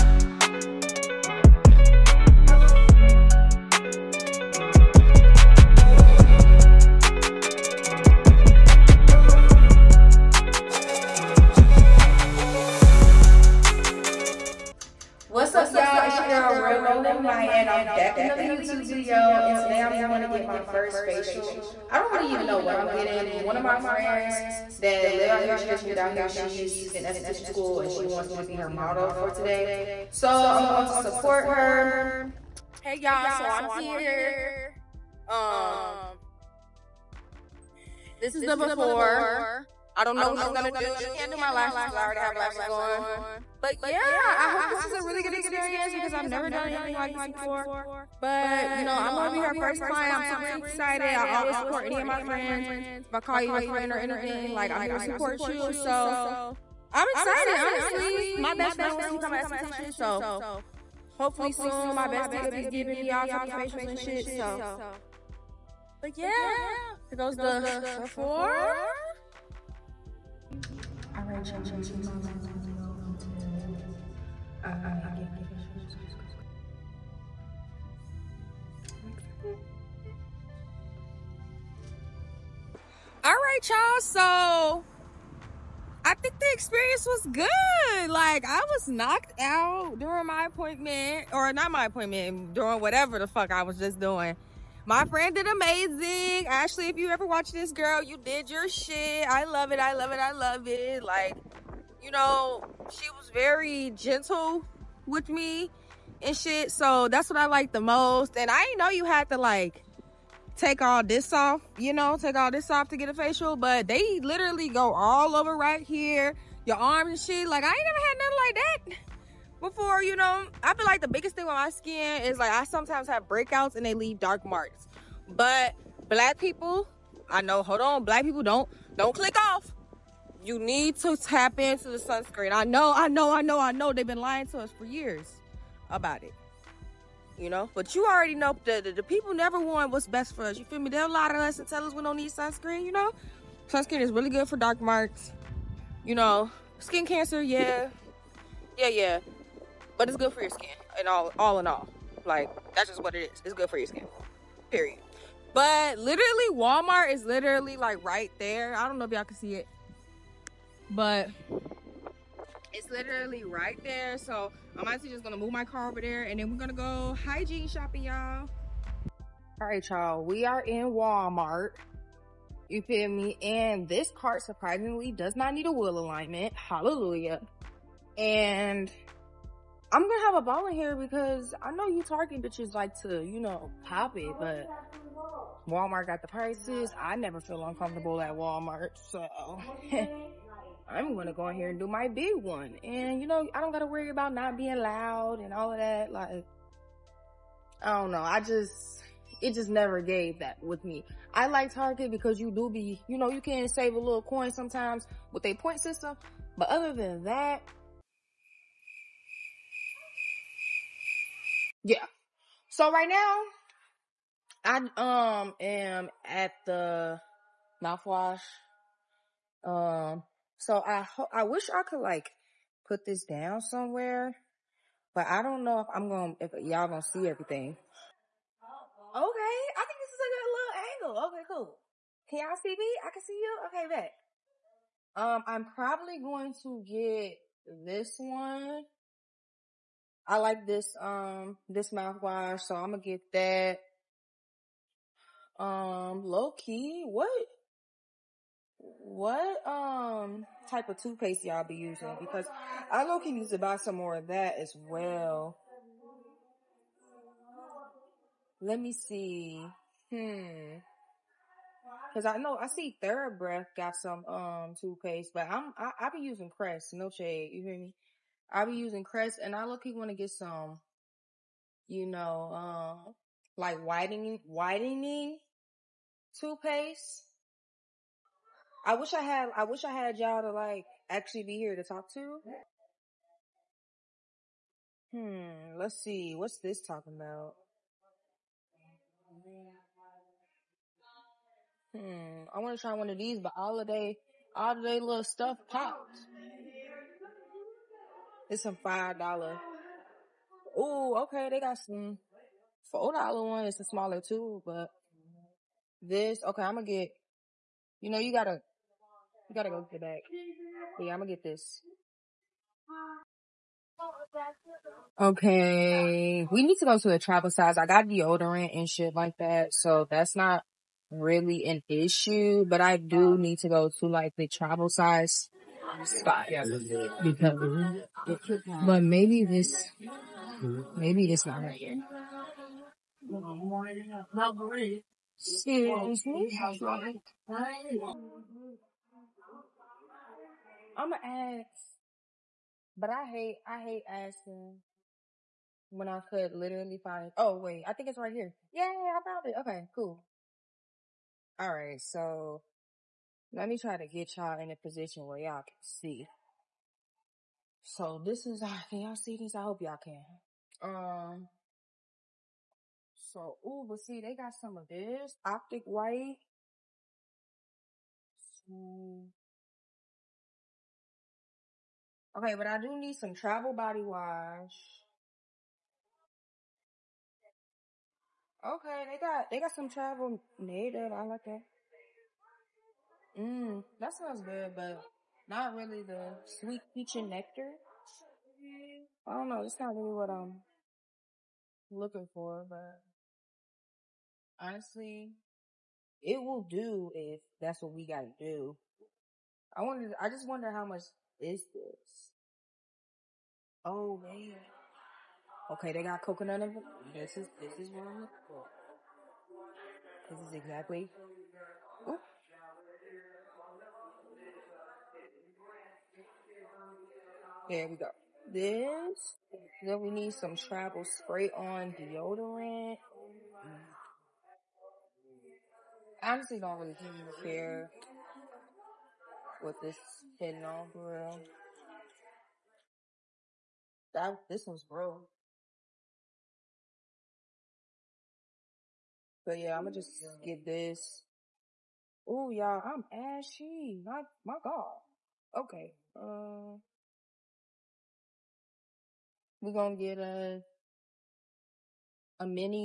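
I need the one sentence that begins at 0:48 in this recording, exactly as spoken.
But you know, I'm gonna be her first client.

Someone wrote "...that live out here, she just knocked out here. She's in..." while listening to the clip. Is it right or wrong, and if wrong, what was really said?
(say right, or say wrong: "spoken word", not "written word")
wrong: "moved", not "knocked".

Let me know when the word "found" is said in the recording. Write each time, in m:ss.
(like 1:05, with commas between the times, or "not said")
5:49.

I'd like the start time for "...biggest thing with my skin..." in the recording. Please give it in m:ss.
2:01.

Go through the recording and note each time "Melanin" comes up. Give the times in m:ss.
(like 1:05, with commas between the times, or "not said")
0:16.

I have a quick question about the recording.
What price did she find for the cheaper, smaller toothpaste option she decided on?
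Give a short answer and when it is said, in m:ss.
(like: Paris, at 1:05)
4 dollars, at 5:02.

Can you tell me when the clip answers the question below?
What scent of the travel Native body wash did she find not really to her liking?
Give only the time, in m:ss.
6:26.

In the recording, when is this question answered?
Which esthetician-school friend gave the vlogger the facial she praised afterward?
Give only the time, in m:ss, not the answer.
1:36.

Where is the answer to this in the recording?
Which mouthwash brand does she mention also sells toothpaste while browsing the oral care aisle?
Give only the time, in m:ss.
4:23.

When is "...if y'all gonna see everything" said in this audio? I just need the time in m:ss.
3:46.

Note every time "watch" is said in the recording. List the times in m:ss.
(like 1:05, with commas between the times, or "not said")
1:37.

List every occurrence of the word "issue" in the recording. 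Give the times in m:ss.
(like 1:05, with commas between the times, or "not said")
5:21.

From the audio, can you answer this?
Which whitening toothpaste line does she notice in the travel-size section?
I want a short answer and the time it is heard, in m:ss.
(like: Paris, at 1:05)
Optic White, at 6:05.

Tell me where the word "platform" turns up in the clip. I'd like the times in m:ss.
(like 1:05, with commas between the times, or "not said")
not said.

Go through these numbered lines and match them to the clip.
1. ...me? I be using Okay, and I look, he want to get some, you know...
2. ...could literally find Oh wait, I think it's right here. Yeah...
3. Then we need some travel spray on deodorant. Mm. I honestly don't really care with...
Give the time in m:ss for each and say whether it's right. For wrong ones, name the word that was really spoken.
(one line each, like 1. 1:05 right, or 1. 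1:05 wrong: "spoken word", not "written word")
1. 4:27 wrong: "Crest", not "Okay"
2. 5:46 right
3. 6:59 right.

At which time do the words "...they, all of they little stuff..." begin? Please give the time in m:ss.
4:53.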